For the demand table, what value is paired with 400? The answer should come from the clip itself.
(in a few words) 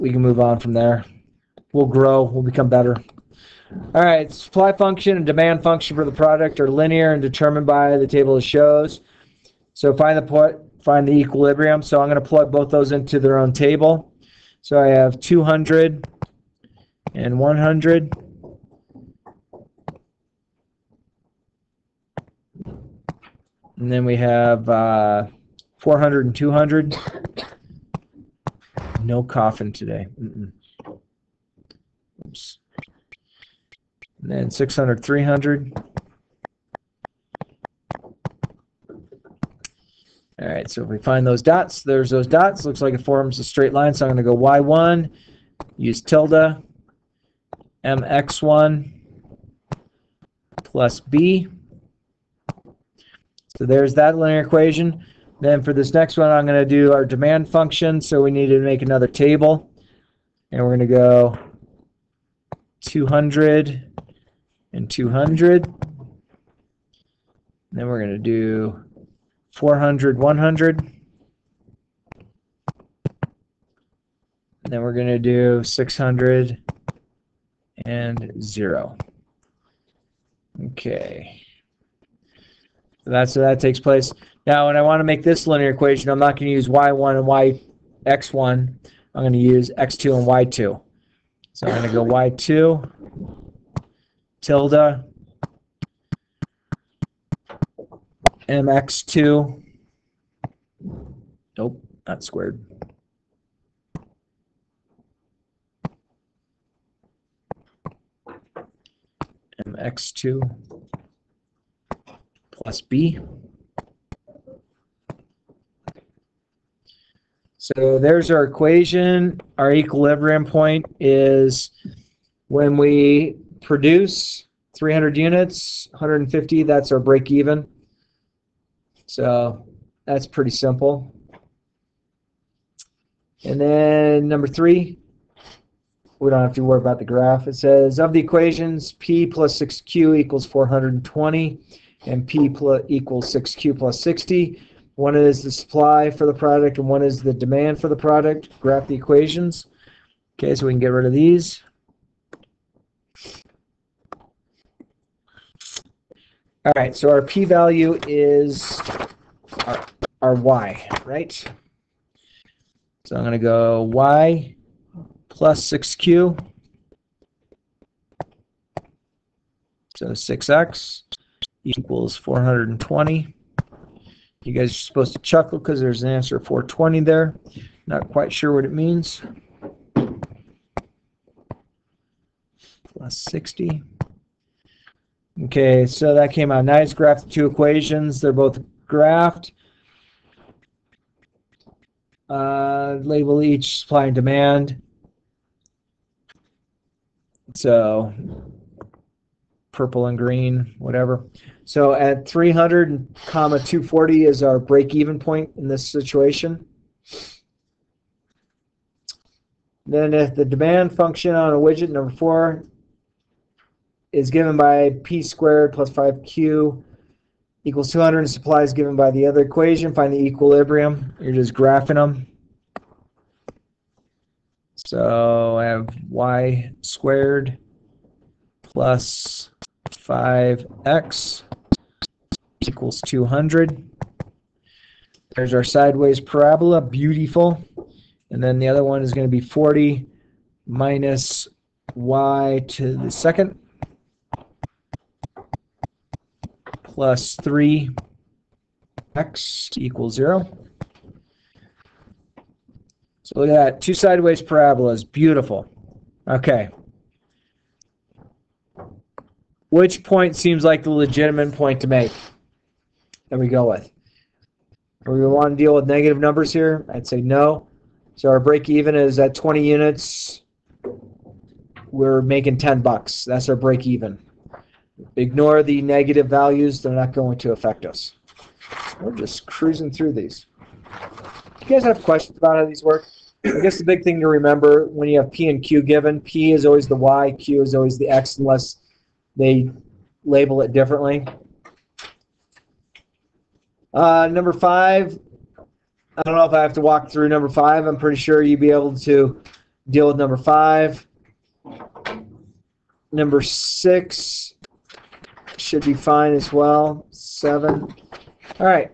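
100.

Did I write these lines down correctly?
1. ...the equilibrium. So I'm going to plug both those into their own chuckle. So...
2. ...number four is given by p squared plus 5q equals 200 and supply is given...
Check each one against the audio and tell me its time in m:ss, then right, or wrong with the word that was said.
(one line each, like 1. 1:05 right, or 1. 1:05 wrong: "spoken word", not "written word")
1. 0:11 wrong: "table", not "chuckle"
2. 3:31 right.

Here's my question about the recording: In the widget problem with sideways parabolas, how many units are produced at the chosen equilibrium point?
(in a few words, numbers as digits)
20.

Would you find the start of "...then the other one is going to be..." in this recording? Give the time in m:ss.
3:58.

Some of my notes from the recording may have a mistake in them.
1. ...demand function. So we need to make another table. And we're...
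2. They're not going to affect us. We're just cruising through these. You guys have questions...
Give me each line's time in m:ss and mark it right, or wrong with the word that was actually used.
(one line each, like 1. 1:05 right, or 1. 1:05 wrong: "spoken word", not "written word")
1. 0:57 right
2. 4:36 right.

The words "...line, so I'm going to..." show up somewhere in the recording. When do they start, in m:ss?
0:43.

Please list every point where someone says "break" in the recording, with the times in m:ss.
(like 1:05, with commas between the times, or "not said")
2:06, 3:24, 4:28, 4:33.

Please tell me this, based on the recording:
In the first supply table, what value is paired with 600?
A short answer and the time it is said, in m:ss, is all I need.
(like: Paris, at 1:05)
300, at 0:34.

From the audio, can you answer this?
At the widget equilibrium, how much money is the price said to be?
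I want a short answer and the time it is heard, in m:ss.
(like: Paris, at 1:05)
10 bucks, at 4:32.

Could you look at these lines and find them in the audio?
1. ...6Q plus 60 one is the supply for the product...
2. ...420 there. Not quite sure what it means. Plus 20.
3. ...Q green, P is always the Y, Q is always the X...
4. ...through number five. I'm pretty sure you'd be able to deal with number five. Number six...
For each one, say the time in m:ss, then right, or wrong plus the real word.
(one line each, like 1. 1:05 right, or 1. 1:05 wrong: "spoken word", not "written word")
1. 2:23 right
2. 2:56 wrong: "60", not "20"
3. 4:45 wrong: "given", not "green"
4. 4:57 right.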